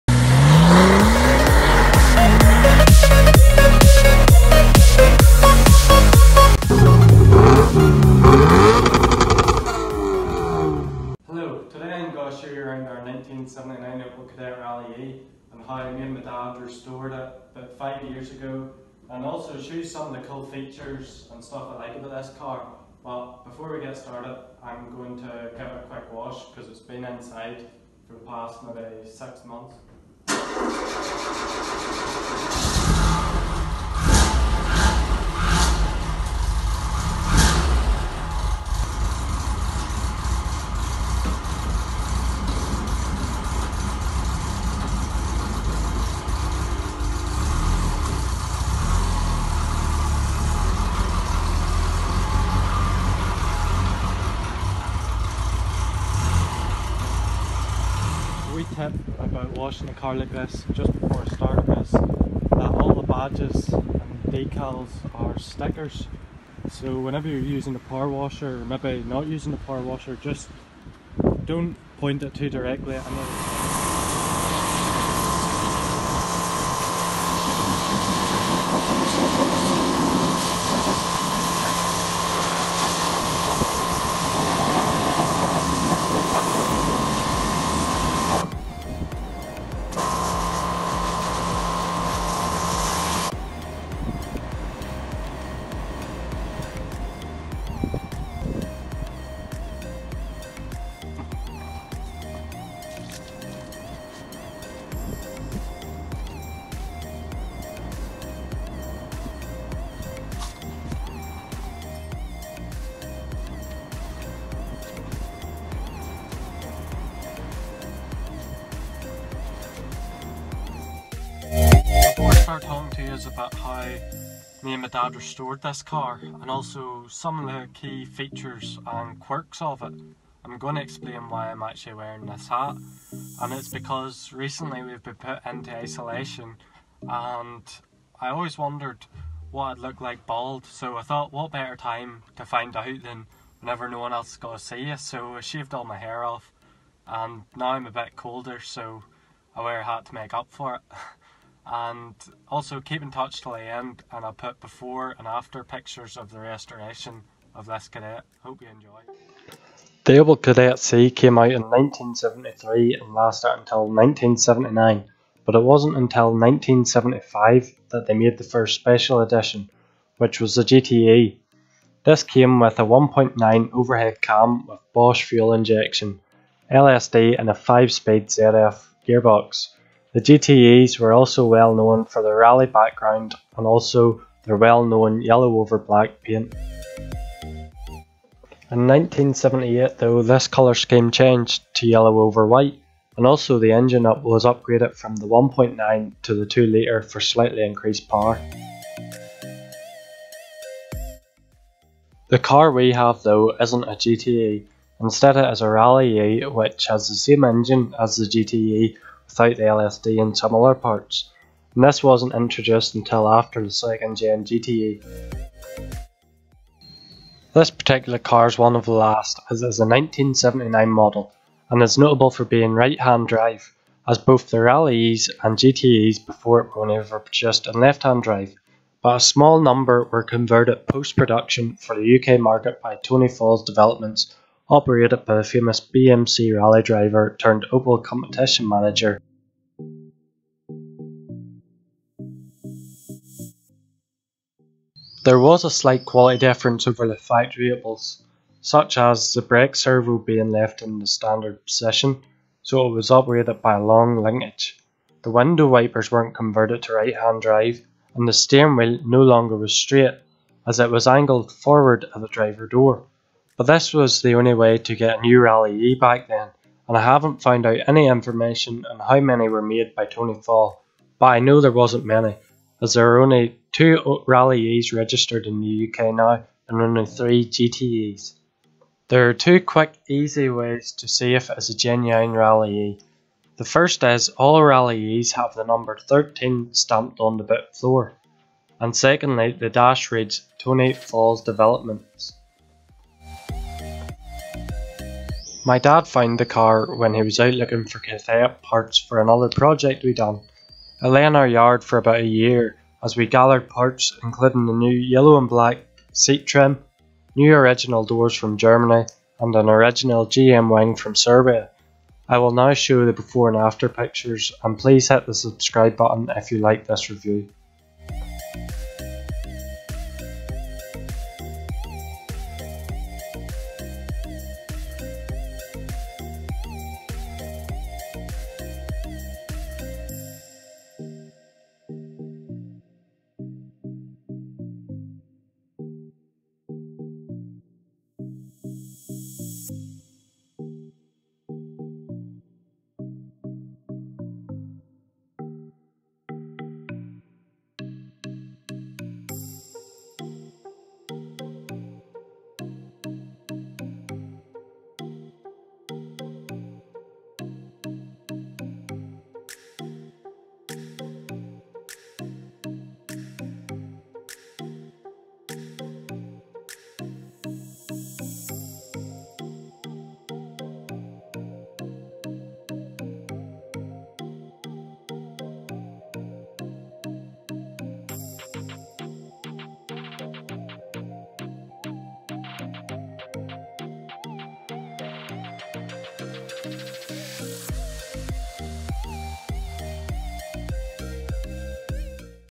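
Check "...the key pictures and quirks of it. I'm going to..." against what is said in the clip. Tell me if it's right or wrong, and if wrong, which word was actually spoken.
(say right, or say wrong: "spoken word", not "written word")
wrong: "features", not "pictures".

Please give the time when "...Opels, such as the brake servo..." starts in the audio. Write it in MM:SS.
04:07.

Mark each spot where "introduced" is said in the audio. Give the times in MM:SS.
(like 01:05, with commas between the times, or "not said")
03:32.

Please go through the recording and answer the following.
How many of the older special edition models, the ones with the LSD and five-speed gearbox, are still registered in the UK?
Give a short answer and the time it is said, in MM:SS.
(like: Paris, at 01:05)
3, at 04:37.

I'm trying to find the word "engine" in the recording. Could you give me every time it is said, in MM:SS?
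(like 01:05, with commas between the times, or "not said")
03:13, 03:27.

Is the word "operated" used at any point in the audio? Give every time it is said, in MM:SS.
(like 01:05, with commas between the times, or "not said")
03:54, 04:13.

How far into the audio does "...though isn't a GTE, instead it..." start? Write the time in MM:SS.
03:23.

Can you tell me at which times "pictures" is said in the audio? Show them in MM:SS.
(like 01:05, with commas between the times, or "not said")
02:35, 05:13.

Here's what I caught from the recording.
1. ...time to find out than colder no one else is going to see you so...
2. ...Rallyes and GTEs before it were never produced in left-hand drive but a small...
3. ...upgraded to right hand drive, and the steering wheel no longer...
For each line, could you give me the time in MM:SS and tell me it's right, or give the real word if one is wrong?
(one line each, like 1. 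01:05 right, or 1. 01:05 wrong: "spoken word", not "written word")
1. 02:21 wrong: "whenever", not "colder"
2. 03:44 right
3. 04:16 wrong: "converted", not "upgraded".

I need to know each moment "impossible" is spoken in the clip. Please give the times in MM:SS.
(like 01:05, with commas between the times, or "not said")
not said.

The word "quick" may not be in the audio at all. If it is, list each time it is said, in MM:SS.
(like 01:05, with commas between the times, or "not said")
00:25, 04:39.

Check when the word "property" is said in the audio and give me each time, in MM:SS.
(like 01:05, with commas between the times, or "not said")
not said.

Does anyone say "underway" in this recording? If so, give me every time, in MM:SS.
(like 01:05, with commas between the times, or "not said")
not said.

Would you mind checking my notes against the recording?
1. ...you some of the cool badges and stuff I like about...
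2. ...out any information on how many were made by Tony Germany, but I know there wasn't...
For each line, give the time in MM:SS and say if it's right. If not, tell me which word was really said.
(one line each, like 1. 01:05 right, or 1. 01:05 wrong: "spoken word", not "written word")
1. 00:19 wrong: "features", not "badges"
2. 04:27 wrong: "Fall", not "Germany".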